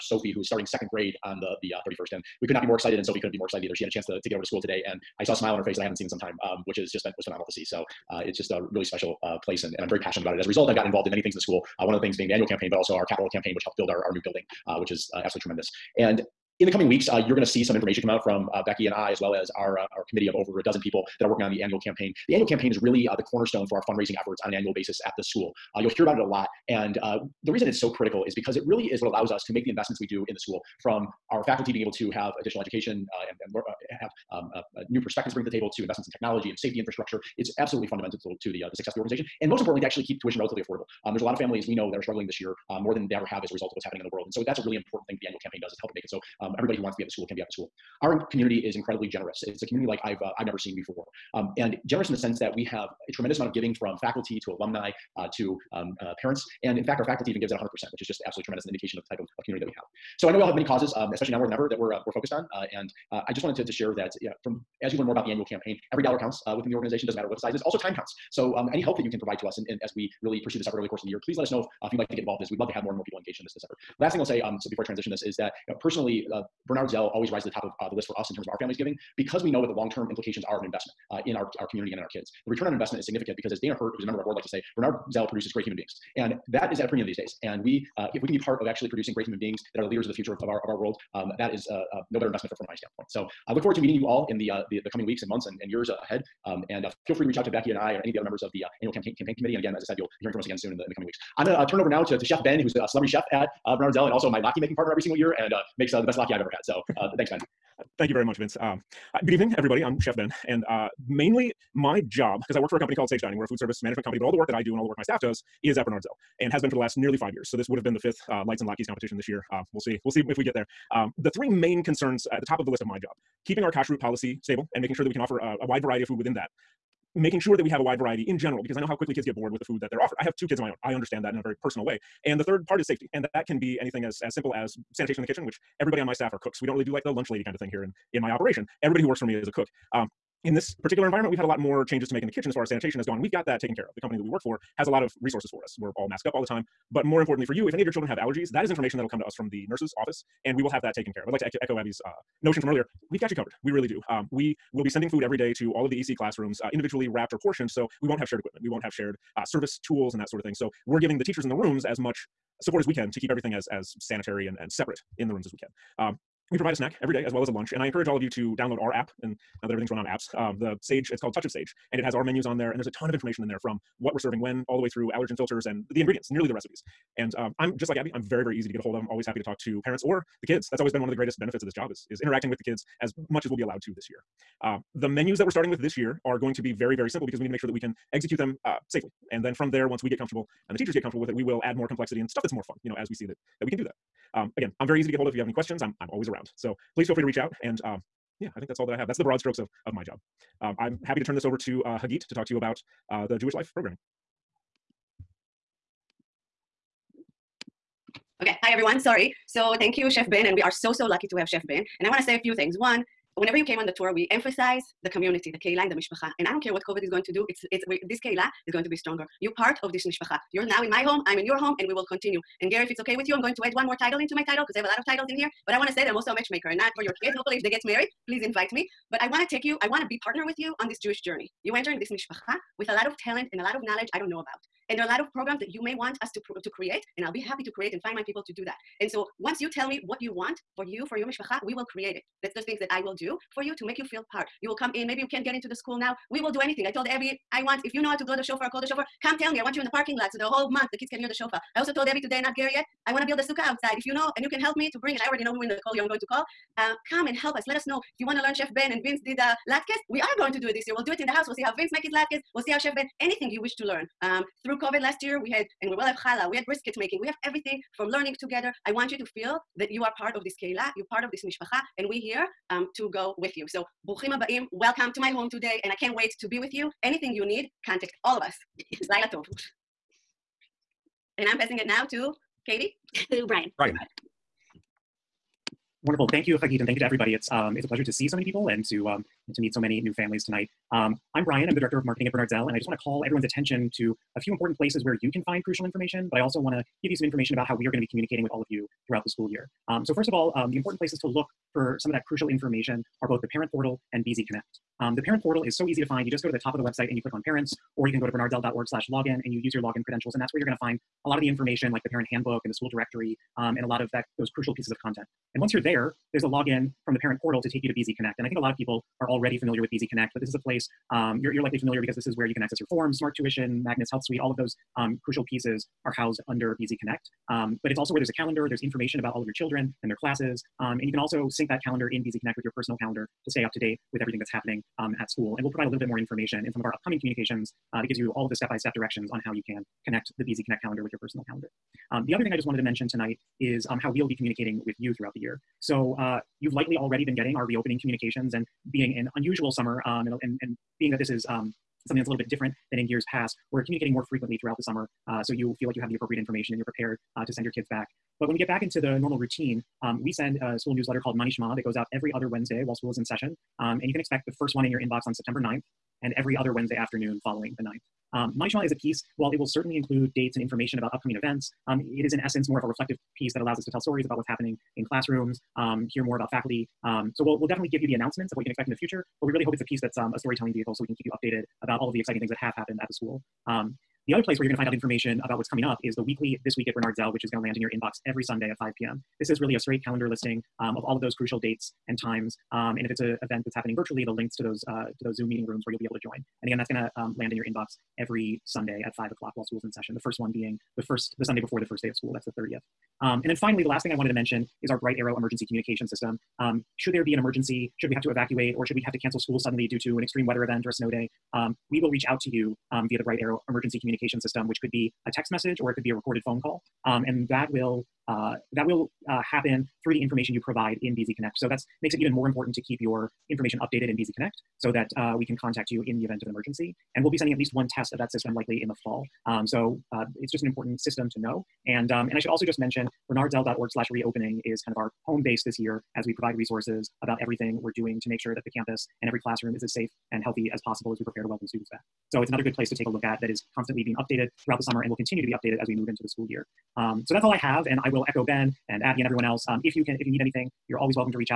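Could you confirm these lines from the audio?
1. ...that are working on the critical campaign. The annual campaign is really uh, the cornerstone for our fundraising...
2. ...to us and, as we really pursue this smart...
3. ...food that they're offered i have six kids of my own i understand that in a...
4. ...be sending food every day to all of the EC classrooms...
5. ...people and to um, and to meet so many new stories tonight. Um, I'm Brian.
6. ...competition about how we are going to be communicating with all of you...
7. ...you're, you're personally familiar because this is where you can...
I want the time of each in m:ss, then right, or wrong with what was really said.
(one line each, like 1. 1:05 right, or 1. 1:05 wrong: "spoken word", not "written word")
1. 0:21 wrong: "annual", not "critical"
2. 1:09 wrong: "effort", not "smart"
3. 2:09 wrong: "two", not "six"
4. 2:34 right
5. 4:48 wrong: "families", not "stories"
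6. 4:57 wrong: "information", not "competition"
7. 5:21 wrong: "likely", not "personally".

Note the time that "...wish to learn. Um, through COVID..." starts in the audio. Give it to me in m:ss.
4:23.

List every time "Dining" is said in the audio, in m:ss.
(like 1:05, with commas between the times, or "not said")
1:53.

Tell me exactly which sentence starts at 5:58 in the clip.
But when we get back into the normal routine, um, we send a school newsletter called Manishma.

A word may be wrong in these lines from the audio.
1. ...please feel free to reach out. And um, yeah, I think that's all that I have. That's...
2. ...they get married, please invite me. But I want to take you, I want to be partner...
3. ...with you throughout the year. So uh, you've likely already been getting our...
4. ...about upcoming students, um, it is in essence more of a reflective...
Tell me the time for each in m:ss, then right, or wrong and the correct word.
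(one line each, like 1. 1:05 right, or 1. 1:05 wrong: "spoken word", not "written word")
1. 3:16 right
2. 3:47 right
3. 5:44 right
4. 6:10 wrong: "events", not "students".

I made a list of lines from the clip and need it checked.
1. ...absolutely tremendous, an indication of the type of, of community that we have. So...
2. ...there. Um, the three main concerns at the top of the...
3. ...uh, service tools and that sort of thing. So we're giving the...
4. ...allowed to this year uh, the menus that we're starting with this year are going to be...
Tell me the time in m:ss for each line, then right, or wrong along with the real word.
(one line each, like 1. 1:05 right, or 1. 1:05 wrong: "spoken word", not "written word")
1. 0:58 right
2. 2:00 right
3. 2:39 right
4. 3:03 right.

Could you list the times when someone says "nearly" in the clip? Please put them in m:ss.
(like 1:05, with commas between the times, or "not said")
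1:56, 2:56.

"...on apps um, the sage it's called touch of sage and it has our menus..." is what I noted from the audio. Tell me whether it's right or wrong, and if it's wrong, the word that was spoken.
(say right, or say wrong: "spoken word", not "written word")
right.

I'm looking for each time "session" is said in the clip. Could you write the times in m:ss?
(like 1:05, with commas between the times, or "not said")
6:03, 6:39.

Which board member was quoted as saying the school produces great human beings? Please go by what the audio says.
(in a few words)
Dana Hurt.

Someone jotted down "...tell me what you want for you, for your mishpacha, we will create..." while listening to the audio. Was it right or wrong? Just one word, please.
right.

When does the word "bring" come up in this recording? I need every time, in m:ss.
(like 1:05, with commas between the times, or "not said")
0:35, 4:14.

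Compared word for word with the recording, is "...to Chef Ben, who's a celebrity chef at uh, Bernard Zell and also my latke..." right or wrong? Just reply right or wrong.
right.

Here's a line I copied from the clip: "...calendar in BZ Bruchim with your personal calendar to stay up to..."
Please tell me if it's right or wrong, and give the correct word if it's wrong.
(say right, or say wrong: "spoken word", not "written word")
wrong: "Connect", not "Bruchim".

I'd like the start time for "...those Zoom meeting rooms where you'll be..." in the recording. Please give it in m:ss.
6:35.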